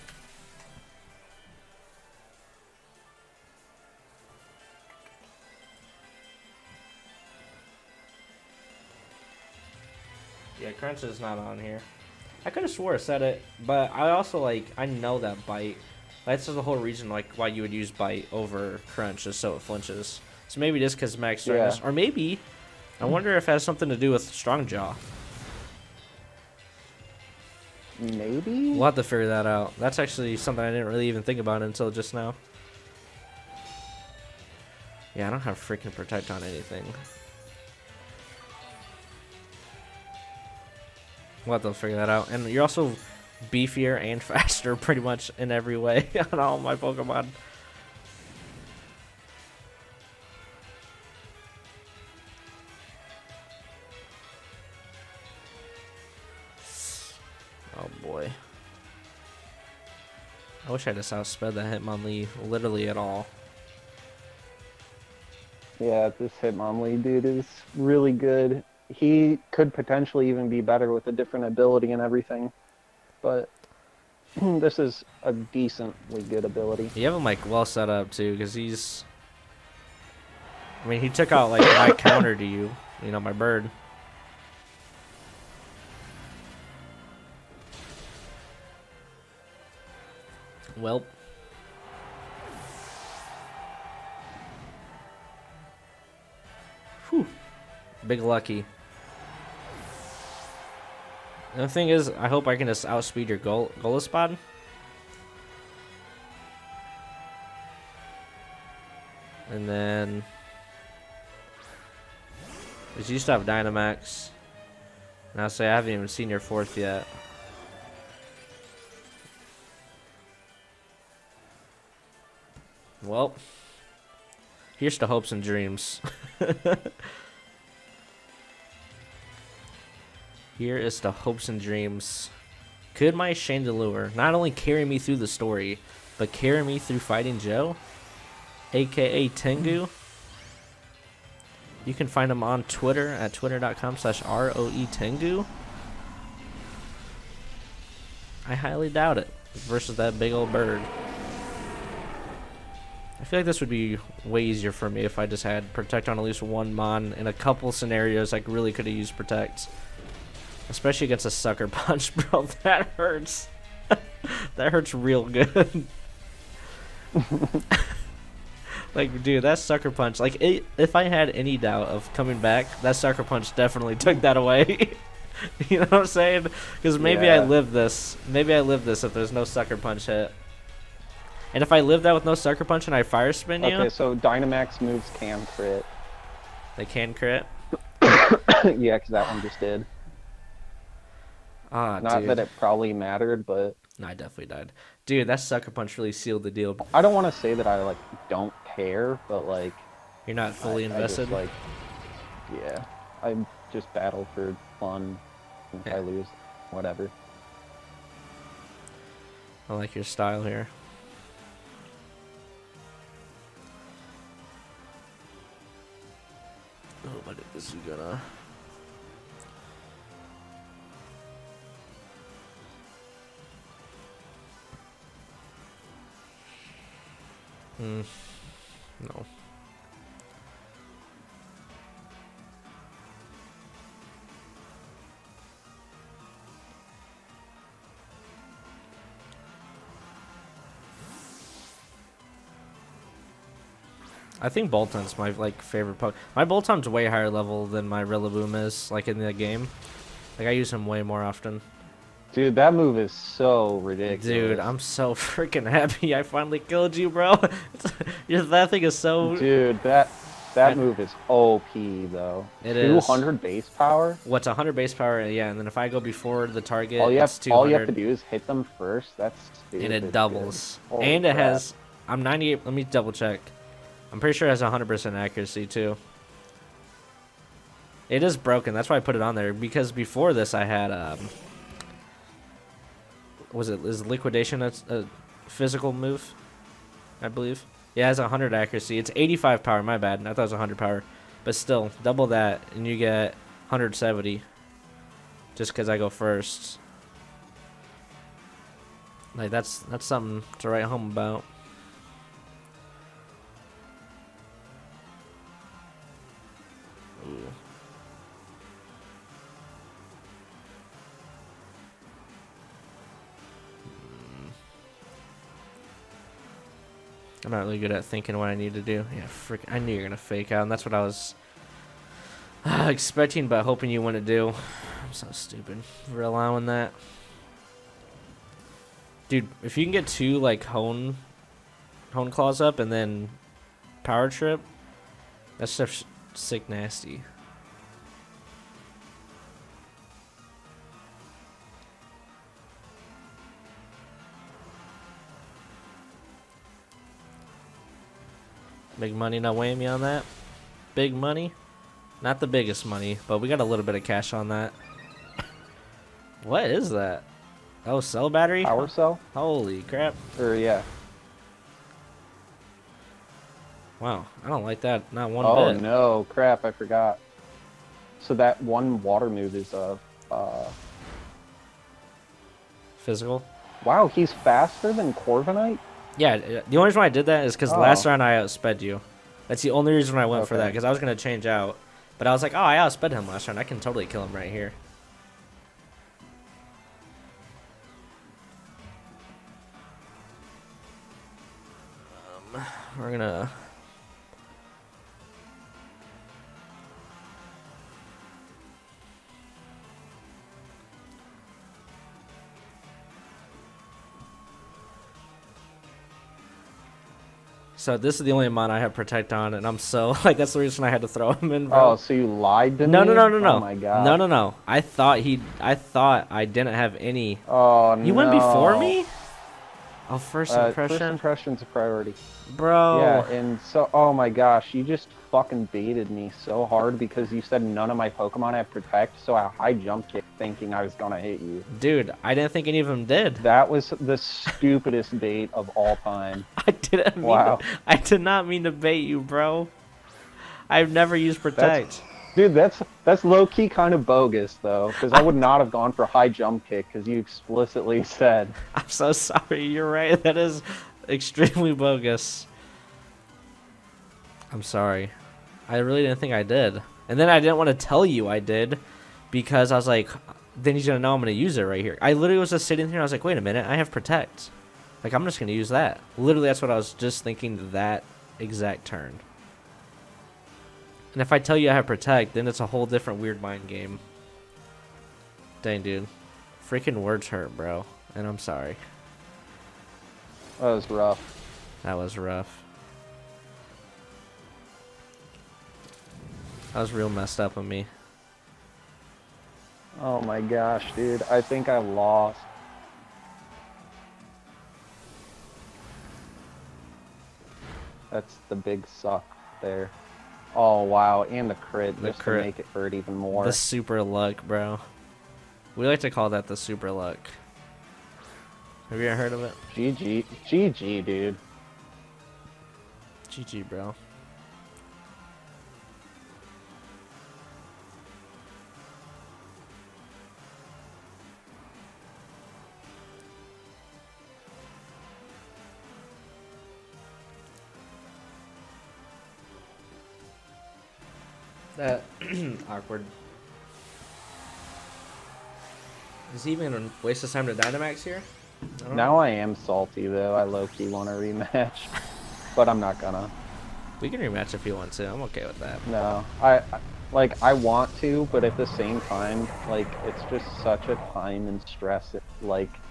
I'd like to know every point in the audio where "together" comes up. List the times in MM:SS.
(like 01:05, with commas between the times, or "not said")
not said.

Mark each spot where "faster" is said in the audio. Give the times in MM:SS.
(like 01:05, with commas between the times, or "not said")
00:44, 06:14.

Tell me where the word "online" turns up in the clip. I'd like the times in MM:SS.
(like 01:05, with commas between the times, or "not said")
not said.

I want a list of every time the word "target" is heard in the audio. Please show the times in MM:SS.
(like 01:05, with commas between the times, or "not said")
04:26.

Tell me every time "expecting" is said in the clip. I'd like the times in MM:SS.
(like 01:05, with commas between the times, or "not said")
05:22.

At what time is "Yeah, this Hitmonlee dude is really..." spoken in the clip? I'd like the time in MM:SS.
01:05.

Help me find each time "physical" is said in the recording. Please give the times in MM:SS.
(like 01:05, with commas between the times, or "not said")
04:45, 06:12.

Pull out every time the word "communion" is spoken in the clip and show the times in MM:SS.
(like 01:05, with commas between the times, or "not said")
not said.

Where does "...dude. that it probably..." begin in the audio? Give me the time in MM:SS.
03:12.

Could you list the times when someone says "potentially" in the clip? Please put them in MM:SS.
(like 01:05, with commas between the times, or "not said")
01:09.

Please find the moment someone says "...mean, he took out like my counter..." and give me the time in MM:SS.
01:20.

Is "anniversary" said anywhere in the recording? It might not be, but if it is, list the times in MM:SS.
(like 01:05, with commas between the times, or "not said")
not said.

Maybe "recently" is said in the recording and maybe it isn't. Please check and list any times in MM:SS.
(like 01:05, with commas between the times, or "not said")
not said.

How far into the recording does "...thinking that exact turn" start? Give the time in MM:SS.
07:47.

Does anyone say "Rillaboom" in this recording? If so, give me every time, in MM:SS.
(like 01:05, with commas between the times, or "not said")
04:08.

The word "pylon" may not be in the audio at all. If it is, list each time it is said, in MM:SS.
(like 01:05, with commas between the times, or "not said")
not said.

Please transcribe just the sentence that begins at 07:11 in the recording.
Dude, I didn't think any of them did.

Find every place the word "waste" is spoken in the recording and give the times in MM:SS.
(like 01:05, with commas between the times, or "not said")
08:57.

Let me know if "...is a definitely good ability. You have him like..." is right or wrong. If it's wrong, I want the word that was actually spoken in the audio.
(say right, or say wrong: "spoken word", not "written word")
wrong: "decently", not "definitely".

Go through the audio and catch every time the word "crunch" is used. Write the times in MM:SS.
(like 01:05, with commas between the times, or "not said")
00:10, 00:18.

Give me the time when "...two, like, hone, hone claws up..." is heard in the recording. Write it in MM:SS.
05:30.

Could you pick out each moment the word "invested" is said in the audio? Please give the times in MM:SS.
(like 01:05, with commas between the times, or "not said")
03:20.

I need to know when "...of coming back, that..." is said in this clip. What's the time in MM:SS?
02:51.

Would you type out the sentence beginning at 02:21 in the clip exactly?
You can find him on Twitter at twitter.com slash ROE Tengu.